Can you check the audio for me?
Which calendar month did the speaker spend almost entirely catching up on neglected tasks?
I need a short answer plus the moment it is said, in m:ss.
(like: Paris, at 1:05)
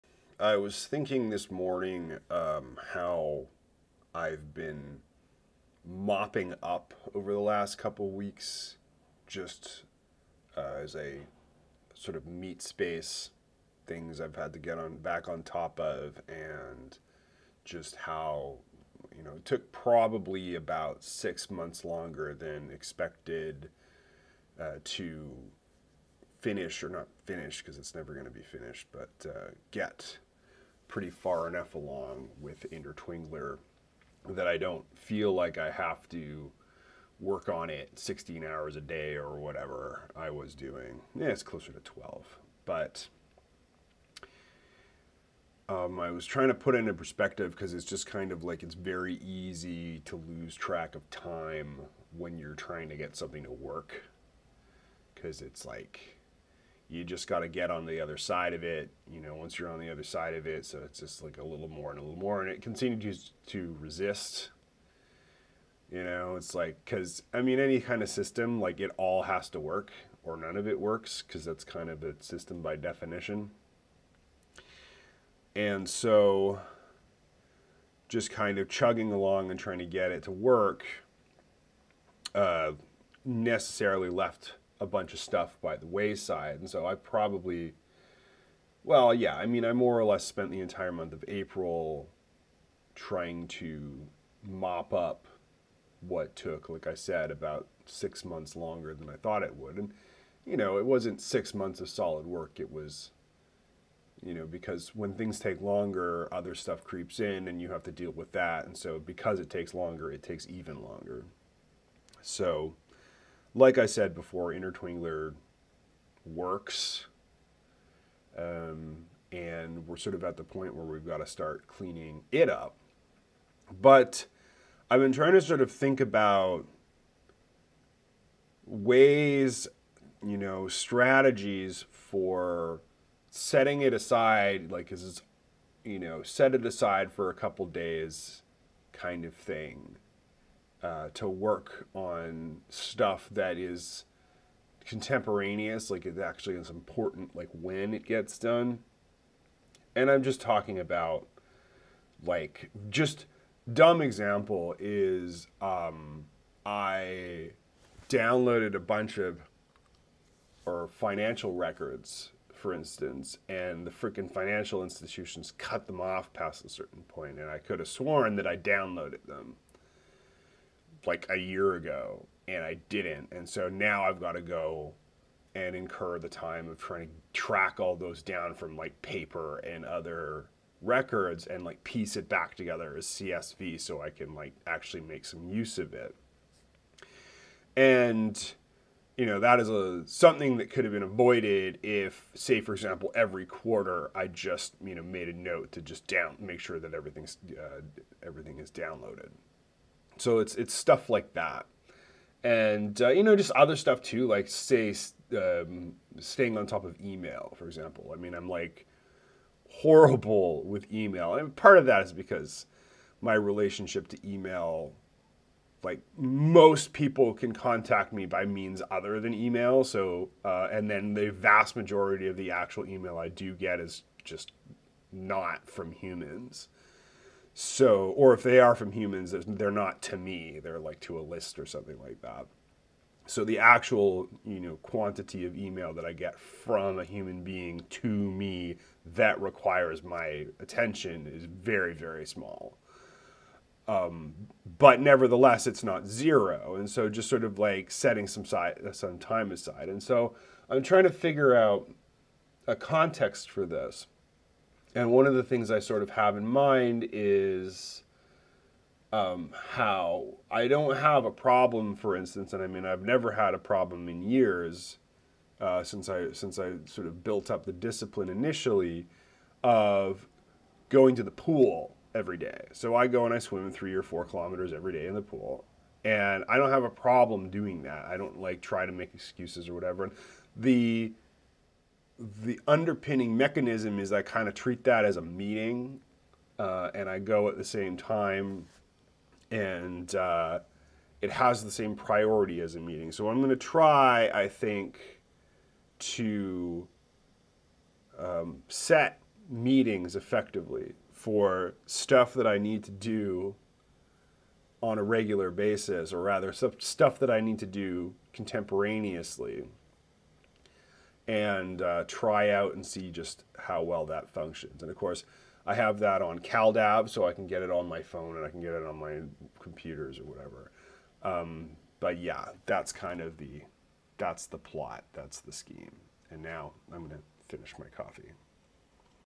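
April, at 1:31.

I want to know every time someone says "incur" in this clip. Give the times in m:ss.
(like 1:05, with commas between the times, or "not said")
2:55.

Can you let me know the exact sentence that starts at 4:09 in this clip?
And so I'm trying to figure out a context for this.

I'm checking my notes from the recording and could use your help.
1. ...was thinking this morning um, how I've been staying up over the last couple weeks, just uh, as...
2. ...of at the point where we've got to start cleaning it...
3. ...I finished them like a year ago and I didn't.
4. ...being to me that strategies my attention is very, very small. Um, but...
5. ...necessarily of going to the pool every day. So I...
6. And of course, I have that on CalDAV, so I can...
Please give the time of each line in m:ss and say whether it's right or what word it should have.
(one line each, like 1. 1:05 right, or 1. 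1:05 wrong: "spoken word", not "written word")
1. 0:00 wrong: "mopping", not "staying"
2. 2:00 right
3. 2:48 wrong: "downloaded", not "finished"
4. 3:57 wrong: "requires", not "strategies"
5. 4:28 wrong: "initially", not "necessarily"
6. 5:14 right.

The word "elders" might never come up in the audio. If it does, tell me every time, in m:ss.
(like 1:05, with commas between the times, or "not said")
not said.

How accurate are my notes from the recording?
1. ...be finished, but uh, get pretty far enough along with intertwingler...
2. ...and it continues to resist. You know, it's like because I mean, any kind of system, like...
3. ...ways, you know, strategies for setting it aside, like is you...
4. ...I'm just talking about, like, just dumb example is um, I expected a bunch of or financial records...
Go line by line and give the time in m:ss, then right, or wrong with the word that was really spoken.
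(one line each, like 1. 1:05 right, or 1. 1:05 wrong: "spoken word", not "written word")
1. 0:28 right
2. 1:02 right
3. 2:08 right
4. 2:30 wrong: "downloaded", not "expected".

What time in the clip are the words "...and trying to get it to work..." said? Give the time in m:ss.
1:19.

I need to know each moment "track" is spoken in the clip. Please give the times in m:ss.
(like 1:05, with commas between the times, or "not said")
0:50, 2:57.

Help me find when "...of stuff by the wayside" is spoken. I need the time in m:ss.
1:25.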